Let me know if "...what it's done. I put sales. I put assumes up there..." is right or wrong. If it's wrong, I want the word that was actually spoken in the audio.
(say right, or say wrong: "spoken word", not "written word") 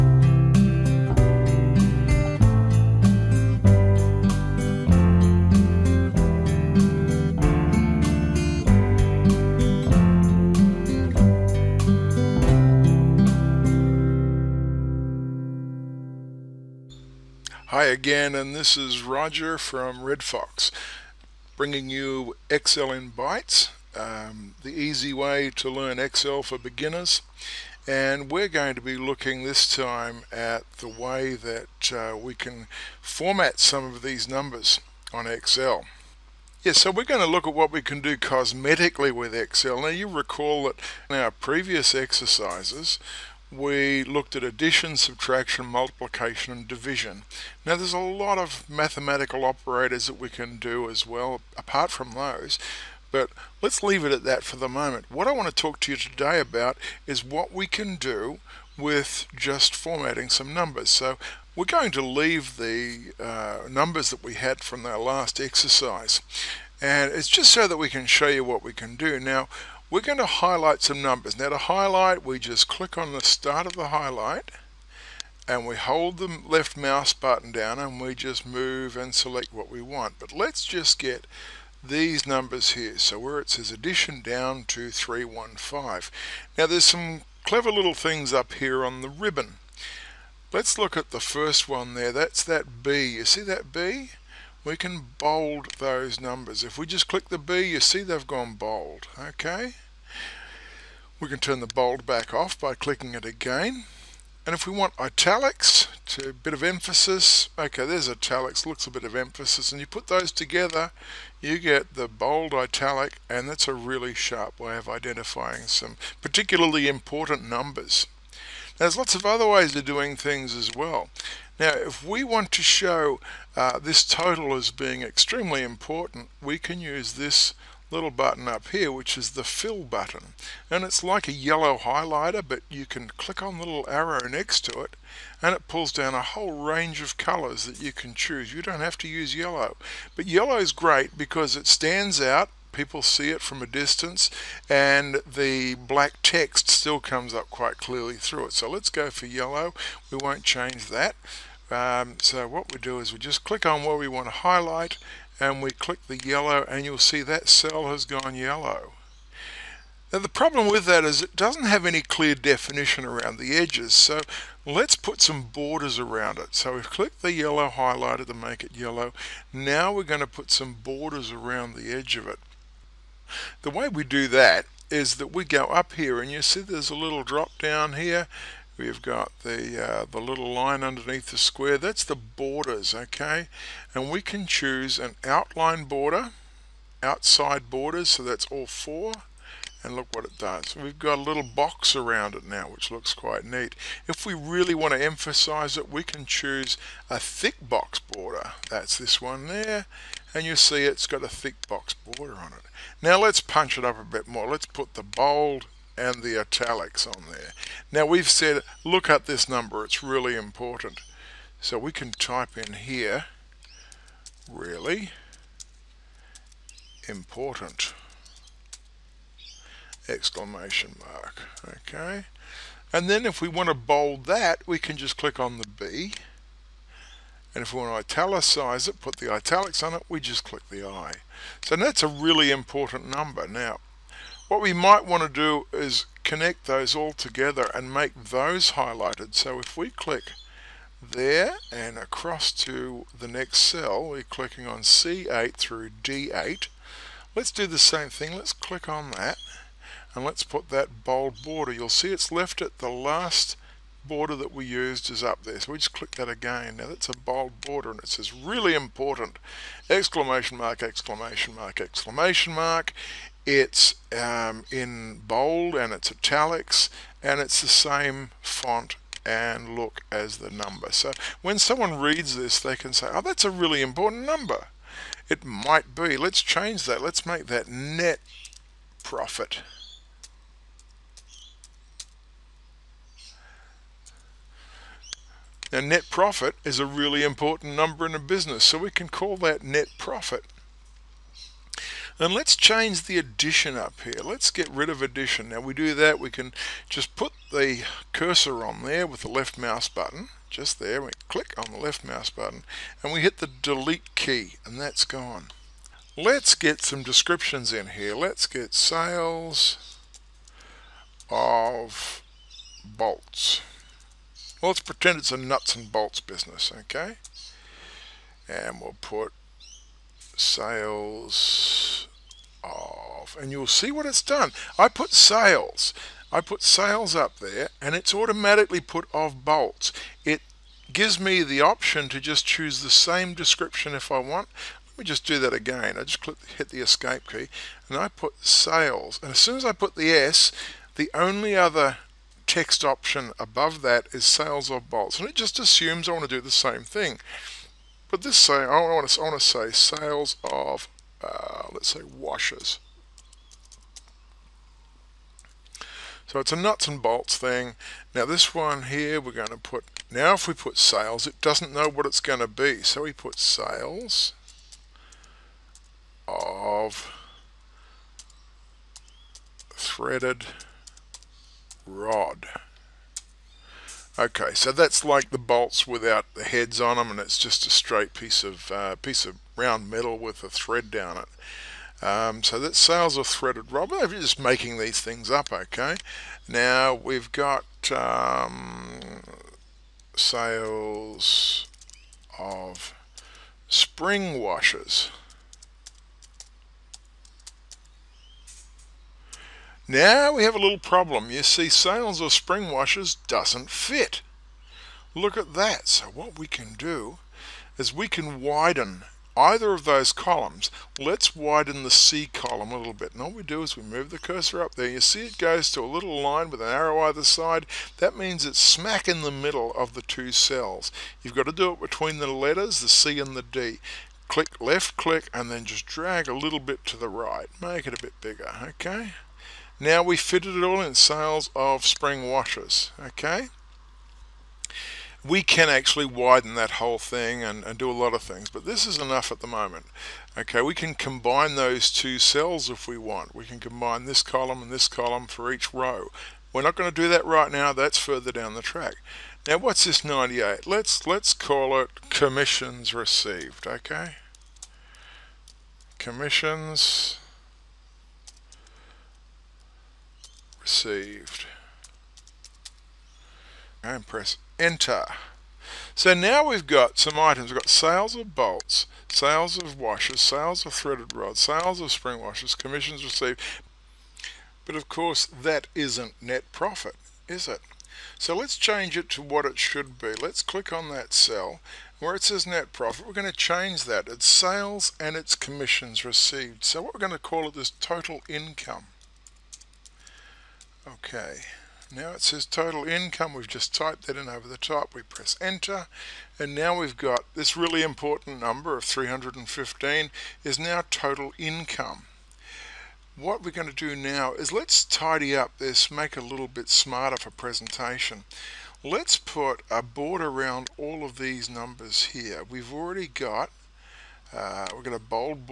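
wrong: "sales", not "assumes".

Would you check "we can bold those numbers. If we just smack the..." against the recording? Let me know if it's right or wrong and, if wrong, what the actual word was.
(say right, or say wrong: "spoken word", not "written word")
wrong: "click", not "smack".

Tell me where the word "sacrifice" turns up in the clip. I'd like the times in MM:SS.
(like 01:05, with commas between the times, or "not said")
not said.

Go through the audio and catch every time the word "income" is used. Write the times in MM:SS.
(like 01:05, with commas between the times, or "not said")
08:08, 08:12, 08:21.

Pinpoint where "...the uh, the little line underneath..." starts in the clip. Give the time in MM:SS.
02:59.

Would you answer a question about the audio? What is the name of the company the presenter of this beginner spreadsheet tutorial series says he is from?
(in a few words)
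Red Fox.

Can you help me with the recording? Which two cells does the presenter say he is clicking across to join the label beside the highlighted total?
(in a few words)
C8 through D8.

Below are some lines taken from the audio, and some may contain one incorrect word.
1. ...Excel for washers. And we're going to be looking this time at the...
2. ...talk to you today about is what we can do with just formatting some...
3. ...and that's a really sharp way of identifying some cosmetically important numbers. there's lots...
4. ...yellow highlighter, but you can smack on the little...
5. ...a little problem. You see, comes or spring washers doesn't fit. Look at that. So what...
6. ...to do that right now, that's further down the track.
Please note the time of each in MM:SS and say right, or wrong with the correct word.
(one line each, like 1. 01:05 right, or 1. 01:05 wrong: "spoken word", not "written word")
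1. 00:25 wrong: "beginners", not "washers"
2. 00:55 right
3. 01:53 wrong: "particularly", not "cosmetically"
4. 02:11 wrong: "click", not "smack"
5. 06:40 wrong: "sales", not "comes"
6. 07:26 right.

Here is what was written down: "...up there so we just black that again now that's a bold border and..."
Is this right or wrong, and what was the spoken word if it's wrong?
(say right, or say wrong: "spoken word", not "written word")
wrong: "click", not "black".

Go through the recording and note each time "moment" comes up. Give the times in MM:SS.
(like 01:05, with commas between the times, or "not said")
00:54, 07:19.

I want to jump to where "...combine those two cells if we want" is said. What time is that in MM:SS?
07:20.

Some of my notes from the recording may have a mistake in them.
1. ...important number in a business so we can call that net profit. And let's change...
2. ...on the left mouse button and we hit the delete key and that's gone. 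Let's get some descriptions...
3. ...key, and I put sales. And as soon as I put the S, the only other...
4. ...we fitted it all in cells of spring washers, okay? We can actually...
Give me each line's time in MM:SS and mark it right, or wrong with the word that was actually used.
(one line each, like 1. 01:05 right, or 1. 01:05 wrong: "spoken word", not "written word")
1. 04:47 right
2. 05:01 right
3. 05:37 right
4. 07:10 right.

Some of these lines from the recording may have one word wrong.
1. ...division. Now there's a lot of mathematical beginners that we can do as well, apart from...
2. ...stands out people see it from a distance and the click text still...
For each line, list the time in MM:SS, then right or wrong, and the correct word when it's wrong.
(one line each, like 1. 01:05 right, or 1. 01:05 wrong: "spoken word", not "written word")
1. 00:46 wrong: "operators", not "beginners"
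2. 02:21 wrong: "black", not "click".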